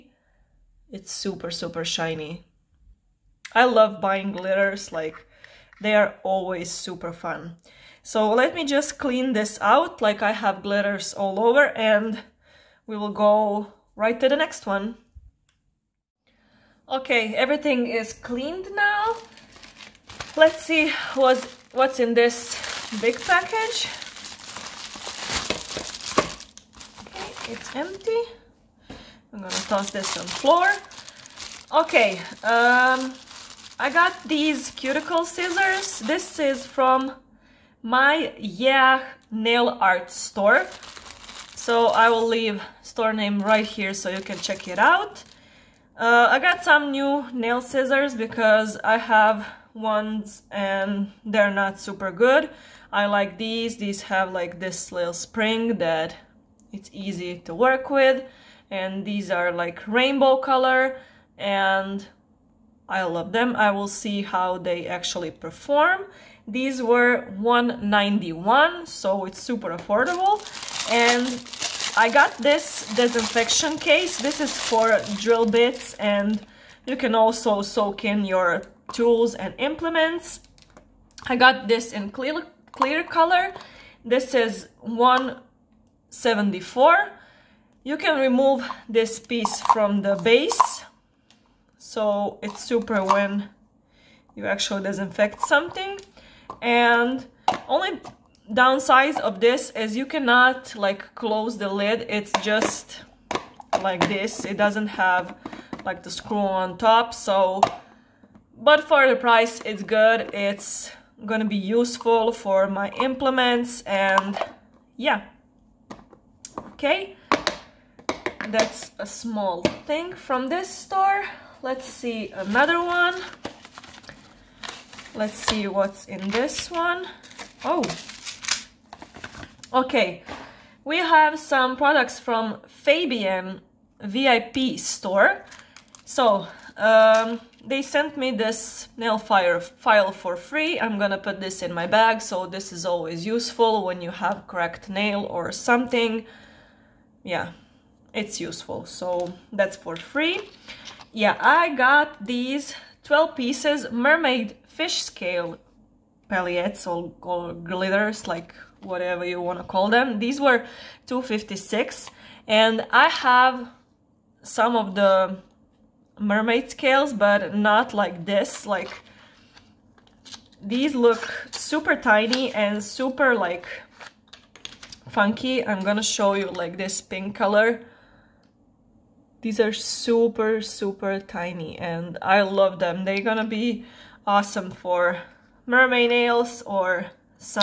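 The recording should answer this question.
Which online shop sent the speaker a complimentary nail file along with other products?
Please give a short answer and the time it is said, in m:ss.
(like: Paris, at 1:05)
Fabian VIP store, at 2:12.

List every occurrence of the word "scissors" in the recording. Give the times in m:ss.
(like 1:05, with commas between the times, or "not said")
0:35, 0:47.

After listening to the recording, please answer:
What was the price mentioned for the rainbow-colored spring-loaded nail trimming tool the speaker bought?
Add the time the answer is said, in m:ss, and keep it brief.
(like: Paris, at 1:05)
191, at 1:07.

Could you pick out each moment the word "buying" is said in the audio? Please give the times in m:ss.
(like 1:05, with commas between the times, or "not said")
0:04.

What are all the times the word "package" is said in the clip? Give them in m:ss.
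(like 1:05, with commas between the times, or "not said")
0:23.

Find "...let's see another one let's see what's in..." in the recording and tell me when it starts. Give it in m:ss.
2:01.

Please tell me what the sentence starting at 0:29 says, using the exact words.
I'm gonna toss this on floor.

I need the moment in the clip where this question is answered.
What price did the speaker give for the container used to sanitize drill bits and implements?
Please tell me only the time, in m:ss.
1:24.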